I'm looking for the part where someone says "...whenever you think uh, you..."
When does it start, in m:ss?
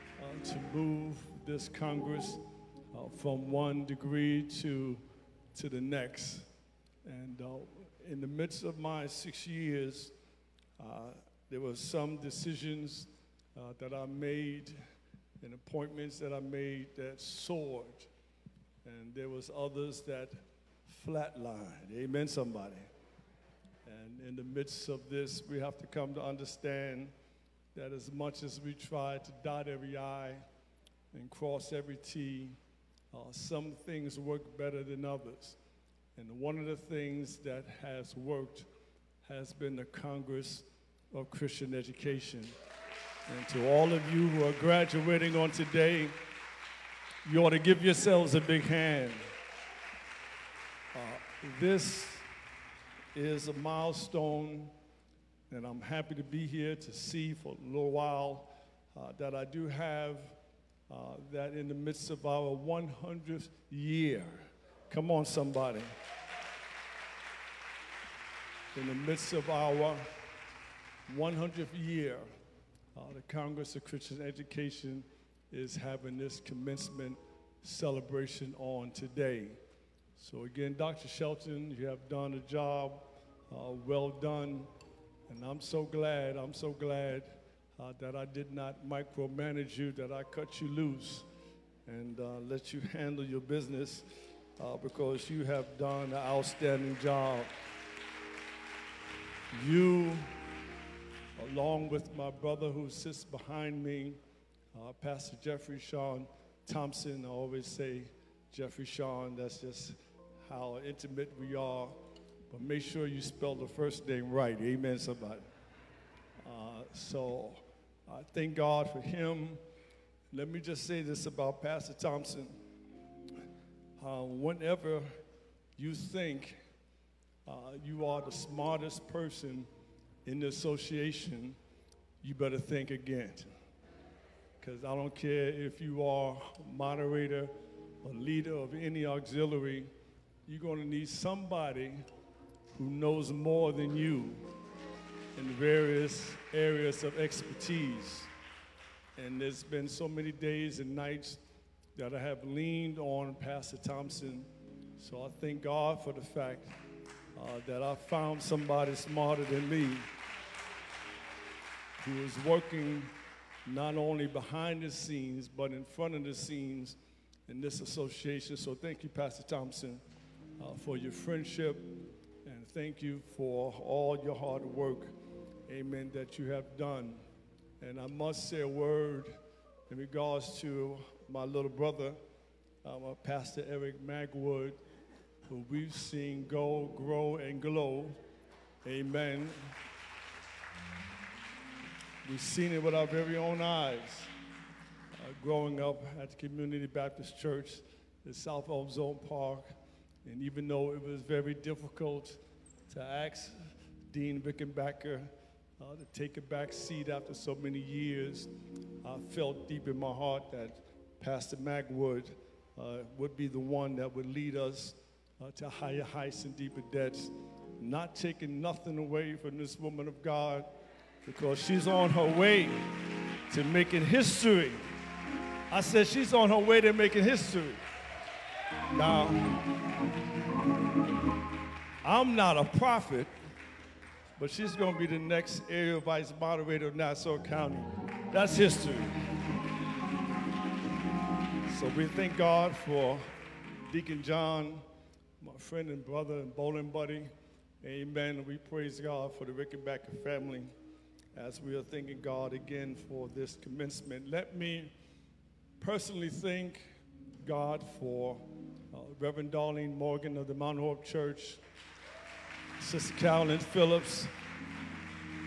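2:04.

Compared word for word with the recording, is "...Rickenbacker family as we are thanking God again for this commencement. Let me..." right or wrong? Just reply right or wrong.
right.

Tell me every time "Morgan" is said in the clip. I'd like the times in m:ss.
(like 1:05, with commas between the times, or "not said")
4:19.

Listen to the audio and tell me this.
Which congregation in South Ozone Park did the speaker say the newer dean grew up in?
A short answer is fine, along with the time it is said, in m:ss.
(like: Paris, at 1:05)
Community Baptist Church, at 3:16.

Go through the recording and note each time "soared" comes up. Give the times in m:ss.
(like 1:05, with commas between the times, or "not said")
0:17.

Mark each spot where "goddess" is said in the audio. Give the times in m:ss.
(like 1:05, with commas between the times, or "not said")
not said.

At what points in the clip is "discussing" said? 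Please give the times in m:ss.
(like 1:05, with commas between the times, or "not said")
not said.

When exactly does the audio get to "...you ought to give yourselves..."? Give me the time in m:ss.
0:47.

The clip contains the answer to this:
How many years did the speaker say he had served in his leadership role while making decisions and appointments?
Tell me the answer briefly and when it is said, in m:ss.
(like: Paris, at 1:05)
6, at 0:09.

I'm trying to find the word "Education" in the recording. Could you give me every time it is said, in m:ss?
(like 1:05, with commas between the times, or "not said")
0:41, 1:14.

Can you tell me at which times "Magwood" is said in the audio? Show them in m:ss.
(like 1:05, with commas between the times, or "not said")
3:04, 3:31.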